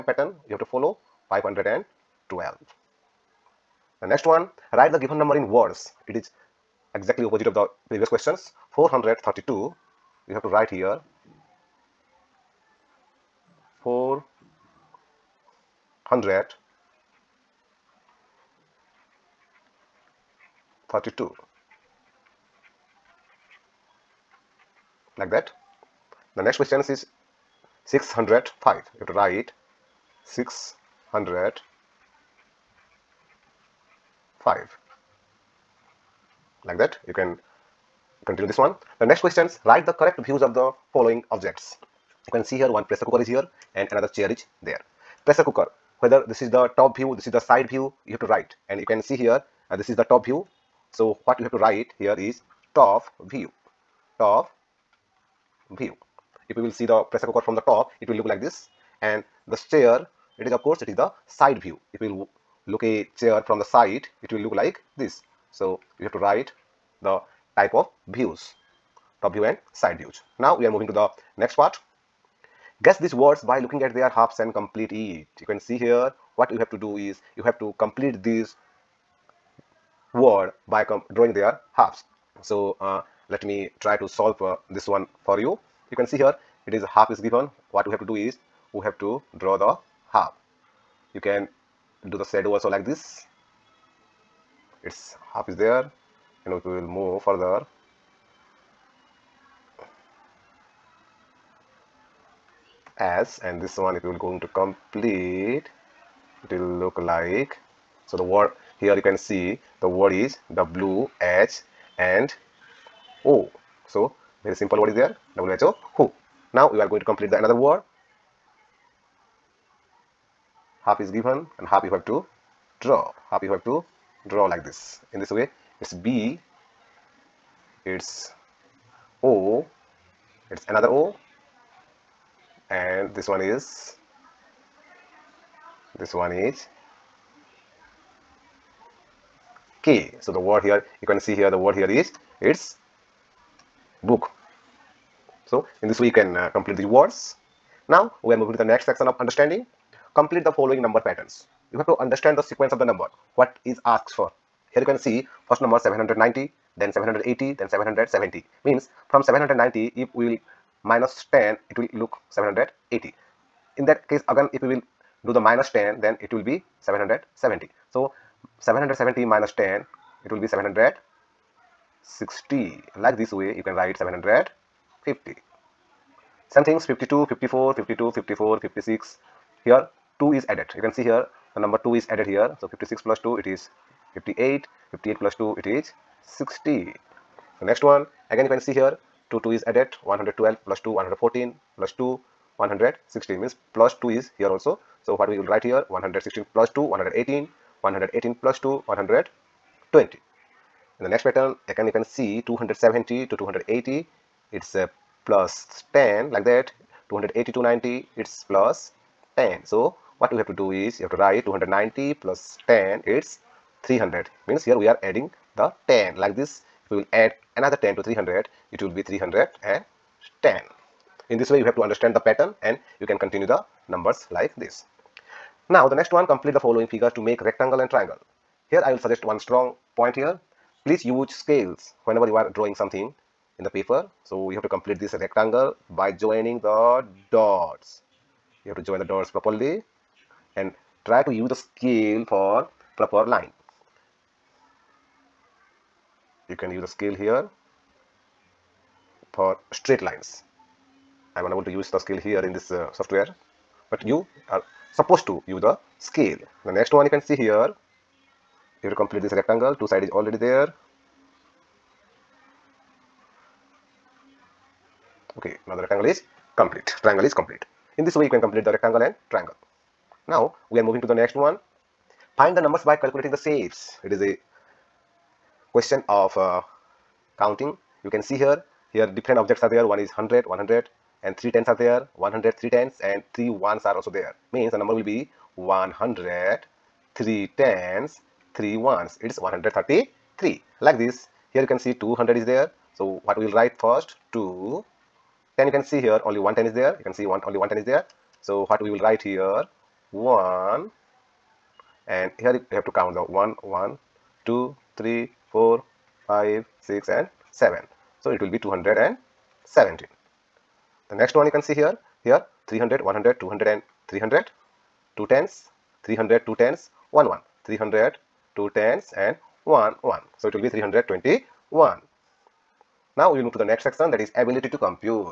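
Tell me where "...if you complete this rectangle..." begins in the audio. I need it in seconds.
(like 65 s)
258 s.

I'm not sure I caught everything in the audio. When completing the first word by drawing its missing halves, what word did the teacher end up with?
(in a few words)
who.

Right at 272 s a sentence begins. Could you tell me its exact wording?
Find the numbers by calculating the shapes.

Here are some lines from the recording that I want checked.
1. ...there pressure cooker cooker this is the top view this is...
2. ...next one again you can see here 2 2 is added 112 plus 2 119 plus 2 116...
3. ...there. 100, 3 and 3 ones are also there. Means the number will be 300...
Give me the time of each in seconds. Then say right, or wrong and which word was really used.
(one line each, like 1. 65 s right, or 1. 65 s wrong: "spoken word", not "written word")
1. 44 s wrong: "whether", not "cooker"
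2. 187 s wrong: "114", not "119"
3. 281 s wrong: "100", not "300".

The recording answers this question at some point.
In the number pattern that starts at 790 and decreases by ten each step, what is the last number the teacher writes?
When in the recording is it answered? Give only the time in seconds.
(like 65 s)
174 s.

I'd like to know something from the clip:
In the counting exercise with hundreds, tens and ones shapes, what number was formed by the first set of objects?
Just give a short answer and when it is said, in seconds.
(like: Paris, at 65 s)
133, at 289 s.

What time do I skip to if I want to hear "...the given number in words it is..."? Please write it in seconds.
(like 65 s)
4 s.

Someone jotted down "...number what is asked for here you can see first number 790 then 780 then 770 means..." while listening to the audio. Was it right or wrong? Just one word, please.
right.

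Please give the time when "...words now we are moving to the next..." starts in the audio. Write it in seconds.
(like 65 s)
146 s.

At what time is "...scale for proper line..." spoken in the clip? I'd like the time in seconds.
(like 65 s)
241 s.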